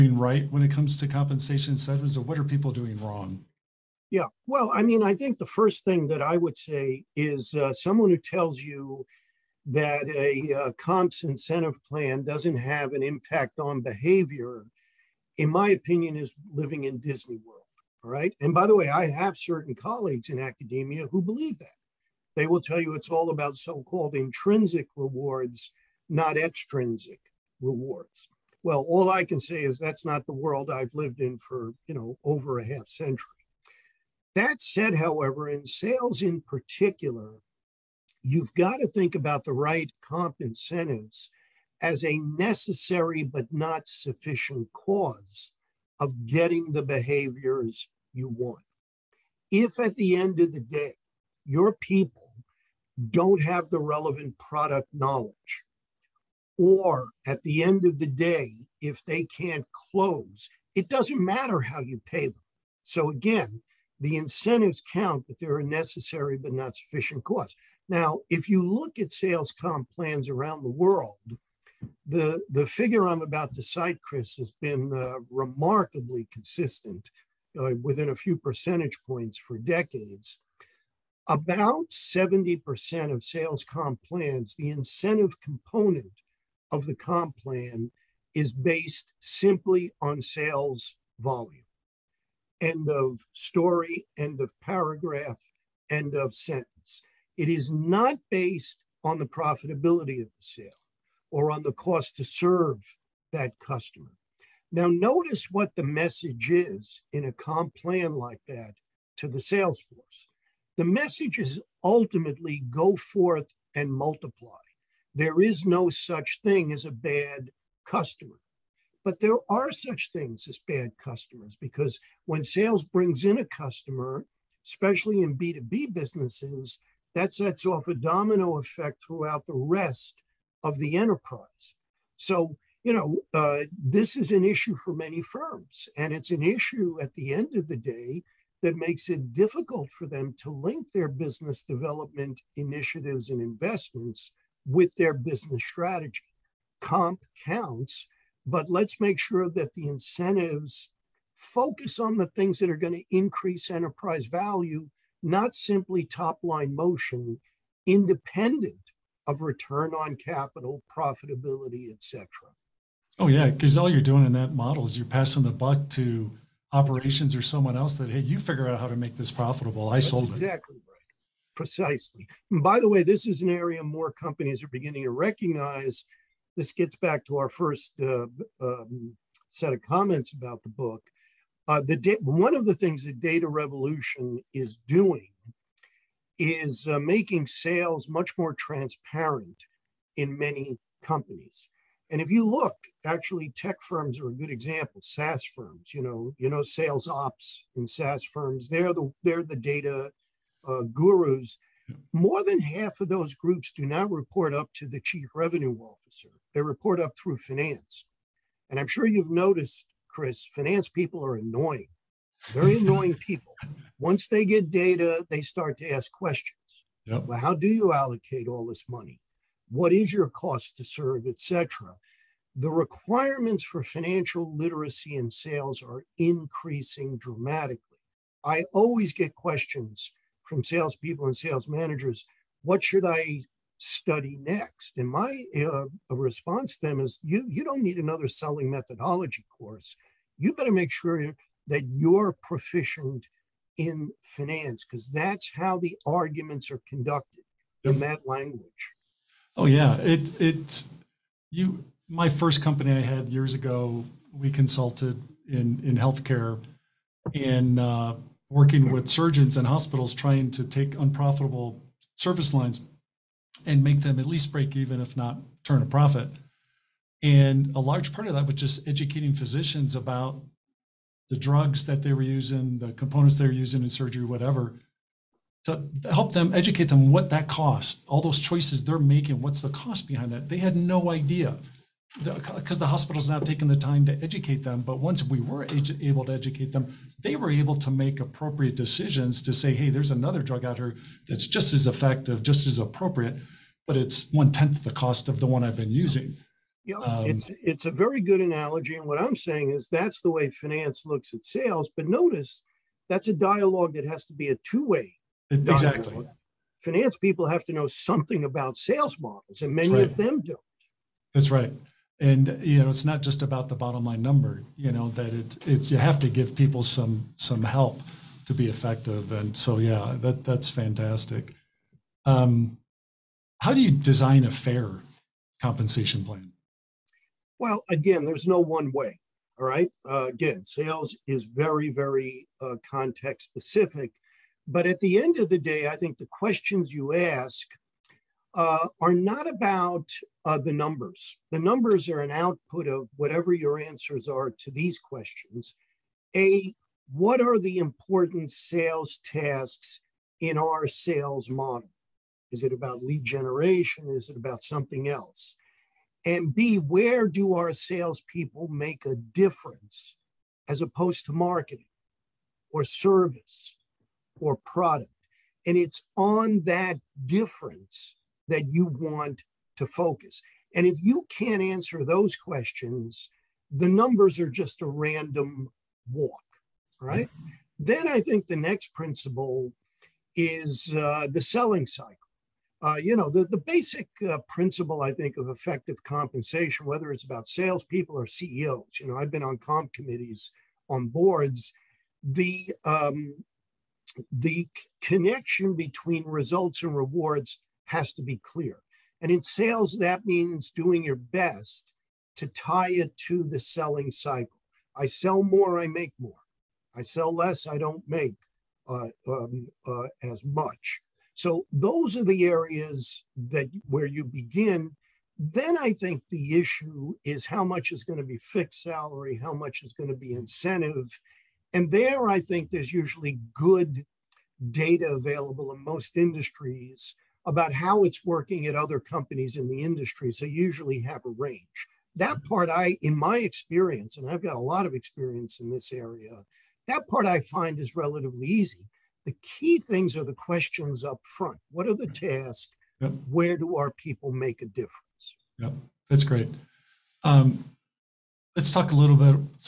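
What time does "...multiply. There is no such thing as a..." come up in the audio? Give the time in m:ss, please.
1:53.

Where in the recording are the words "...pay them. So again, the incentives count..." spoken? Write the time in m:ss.
1:02.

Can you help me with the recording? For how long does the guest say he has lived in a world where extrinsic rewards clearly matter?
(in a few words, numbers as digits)
Over a half century.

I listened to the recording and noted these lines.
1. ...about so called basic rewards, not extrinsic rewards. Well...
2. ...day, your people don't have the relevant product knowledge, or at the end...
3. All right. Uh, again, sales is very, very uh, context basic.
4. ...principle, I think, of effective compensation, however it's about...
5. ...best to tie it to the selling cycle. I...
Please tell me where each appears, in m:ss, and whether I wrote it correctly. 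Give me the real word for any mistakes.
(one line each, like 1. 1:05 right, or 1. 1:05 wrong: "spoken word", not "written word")
1. 0:23 wrong: "intrinsic", not "basic"
2. 0:50 right
3. 5:29 wrong: "specific", not "basic"
4. 6:24 wrong: "whether", not "however"
5. 6:41 right.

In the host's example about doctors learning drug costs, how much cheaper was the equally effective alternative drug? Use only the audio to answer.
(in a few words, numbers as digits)
One tenth the cost.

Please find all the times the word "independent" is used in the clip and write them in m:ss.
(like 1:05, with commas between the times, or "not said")
2:37.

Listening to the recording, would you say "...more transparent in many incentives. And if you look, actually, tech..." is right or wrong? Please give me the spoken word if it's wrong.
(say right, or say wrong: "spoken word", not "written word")
wrong: "companies", not "incentives".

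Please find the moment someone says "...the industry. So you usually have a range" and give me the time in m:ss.
7:09.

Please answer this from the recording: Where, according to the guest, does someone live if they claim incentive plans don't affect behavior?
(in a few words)
Disney World.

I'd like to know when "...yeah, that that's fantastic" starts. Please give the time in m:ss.
5:19.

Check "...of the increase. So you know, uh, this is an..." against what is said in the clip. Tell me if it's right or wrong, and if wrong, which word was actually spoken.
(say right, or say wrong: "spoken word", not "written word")
wrong: "enterprise", not "increase".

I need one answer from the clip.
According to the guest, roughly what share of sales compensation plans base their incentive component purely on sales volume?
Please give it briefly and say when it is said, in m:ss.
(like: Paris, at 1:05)
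70%, at 1:21.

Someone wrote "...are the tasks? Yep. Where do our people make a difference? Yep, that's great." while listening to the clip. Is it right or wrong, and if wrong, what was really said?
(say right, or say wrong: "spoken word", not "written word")
right.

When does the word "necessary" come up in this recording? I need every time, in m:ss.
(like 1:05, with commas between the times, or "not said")
0:42, 1:05.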